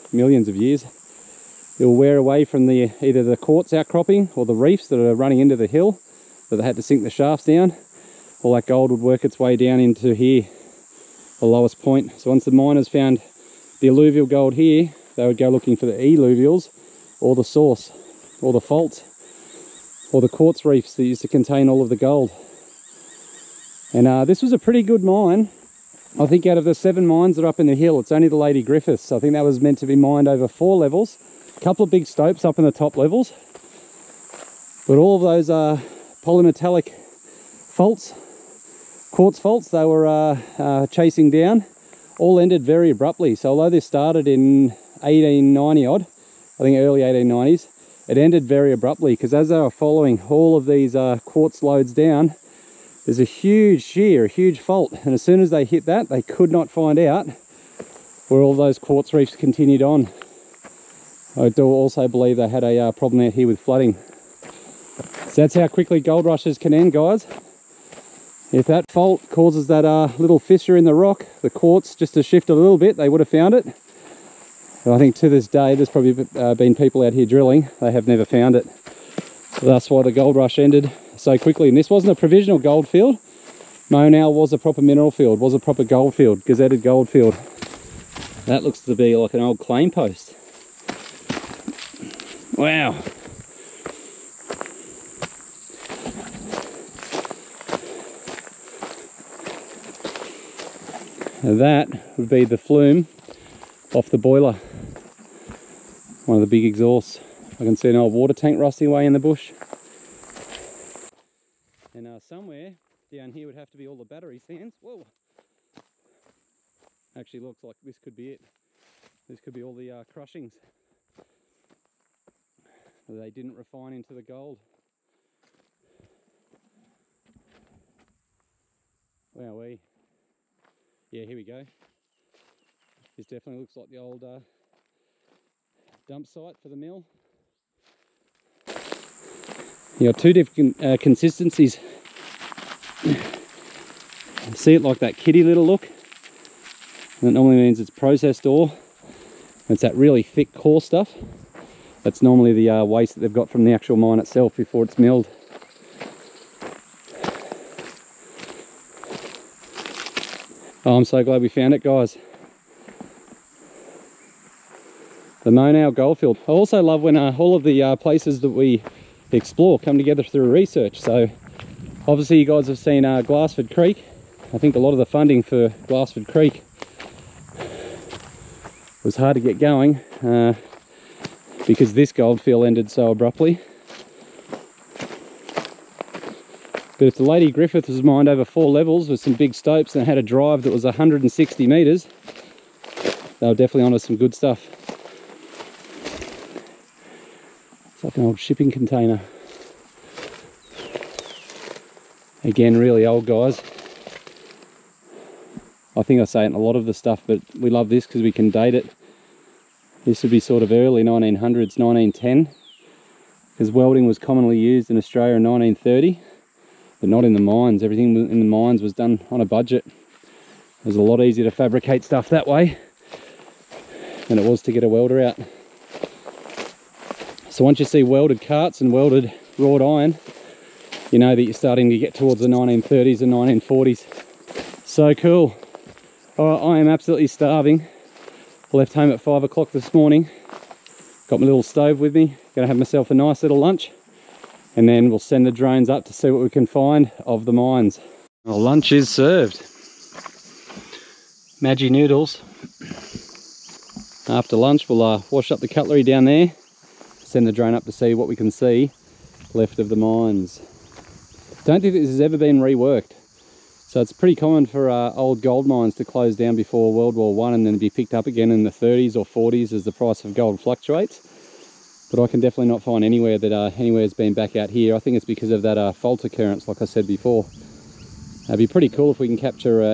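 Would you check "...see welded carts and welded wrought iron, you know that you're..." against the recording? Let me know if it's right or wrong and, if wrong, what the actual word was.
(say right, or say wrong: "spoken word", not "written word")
right.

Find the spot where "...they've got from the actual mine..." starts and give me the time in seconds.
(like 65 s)
153 s.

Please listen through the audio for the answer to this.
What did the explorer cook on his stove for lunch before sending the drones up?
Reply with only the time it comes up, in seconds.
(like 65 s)
251 s.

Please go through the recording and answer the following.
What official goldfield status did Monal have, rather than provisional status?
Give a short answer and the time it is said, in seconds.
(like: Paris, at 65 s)
gazetted gold field, at 86 s.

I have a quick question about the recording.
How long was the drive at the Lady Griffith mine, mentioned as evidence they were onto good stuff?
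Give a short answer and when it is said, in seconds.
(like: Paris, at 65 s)
160 metres, at 190 s.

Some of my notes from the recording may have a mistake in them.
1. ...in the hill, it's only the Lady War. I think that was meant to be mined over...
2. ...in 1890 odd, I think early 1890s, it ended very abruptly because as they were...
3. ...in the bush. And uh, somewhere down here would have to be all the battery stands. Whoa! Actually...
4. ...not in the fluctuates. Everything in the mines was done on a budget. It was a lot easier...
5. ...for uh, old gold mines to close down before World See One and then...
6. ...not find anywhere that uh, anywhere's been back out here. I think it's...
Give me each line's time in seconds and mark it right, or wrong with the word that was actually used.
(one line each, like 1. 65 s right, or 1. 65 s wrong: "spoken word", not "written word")
1. 27 s wrong: "Griffiths", not "War"
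2. 44 s right
3. 109 s right
4. 217 s wrong: "mines", not "fluctuates"
5. 264 s wrong: "War", not "See"
6. 272 s right.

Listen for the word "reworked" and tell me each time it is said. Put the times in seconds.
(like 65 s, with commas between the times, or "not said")
262 s.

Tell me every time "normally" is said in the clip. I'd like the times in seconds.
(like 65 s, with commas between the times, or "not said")
147 s, 152 s.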